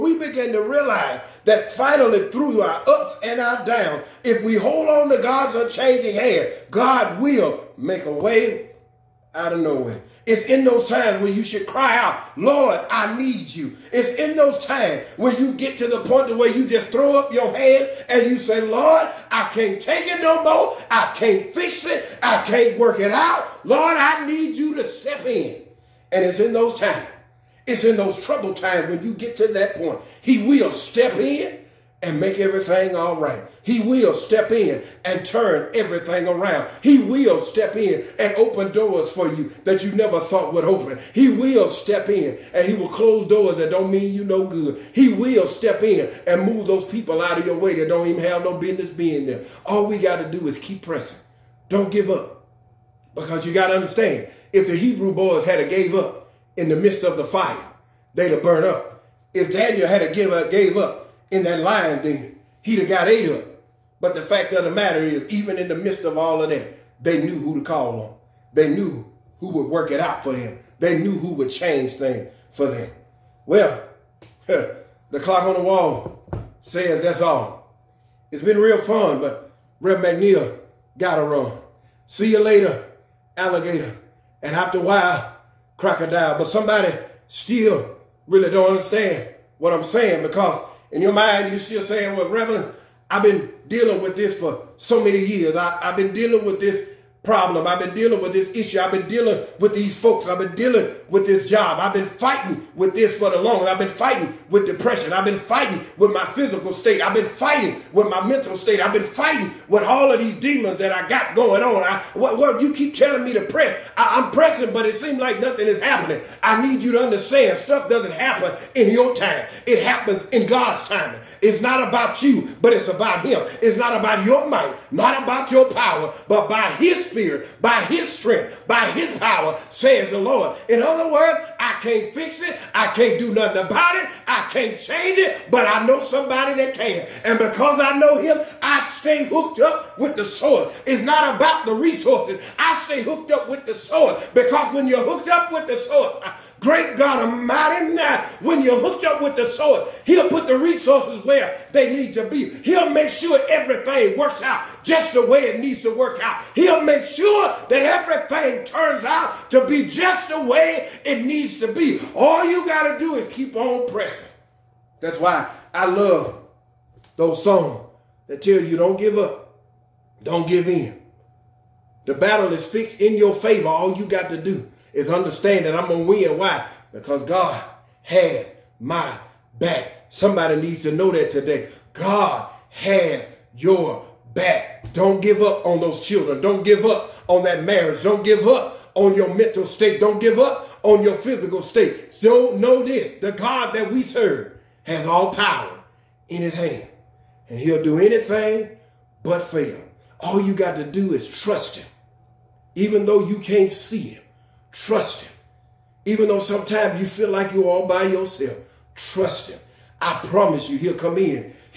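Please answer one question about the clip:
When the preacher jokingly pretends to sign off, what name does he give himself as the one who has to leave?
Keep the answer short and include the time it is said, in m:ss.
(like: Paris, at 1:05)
Rev McNeil, at 1:19.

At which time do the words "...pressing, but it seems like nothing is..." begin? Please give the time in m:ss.
1:54.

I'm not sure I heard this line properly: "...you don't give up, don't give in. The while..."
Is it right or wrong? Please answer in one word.
wrong.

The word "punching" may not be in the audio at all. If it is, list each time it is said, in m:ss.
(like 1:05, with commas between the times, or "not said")
not said.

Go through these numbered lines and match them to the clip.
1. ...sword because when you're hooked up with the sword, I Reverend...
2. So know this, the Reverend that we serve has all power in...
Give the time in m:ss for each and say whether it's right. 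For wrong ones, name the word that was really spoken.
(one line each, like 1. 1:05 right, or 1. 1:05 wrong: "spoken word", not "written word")
1. 2:23 wrong: "Great", not "Reverend"
2. 3:12 wrong: "God", not "Reverend".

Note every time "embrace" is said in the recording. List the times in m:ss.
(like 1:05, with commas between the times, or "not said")
not said.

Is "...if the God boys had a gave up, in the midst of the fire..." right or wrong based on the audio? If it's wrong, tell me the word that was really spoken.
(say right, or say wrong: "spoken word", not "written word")
wrong: "Hebrew", not "God".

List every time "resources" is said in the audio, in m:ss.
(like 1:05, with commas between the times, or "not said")
2:21, 2:30.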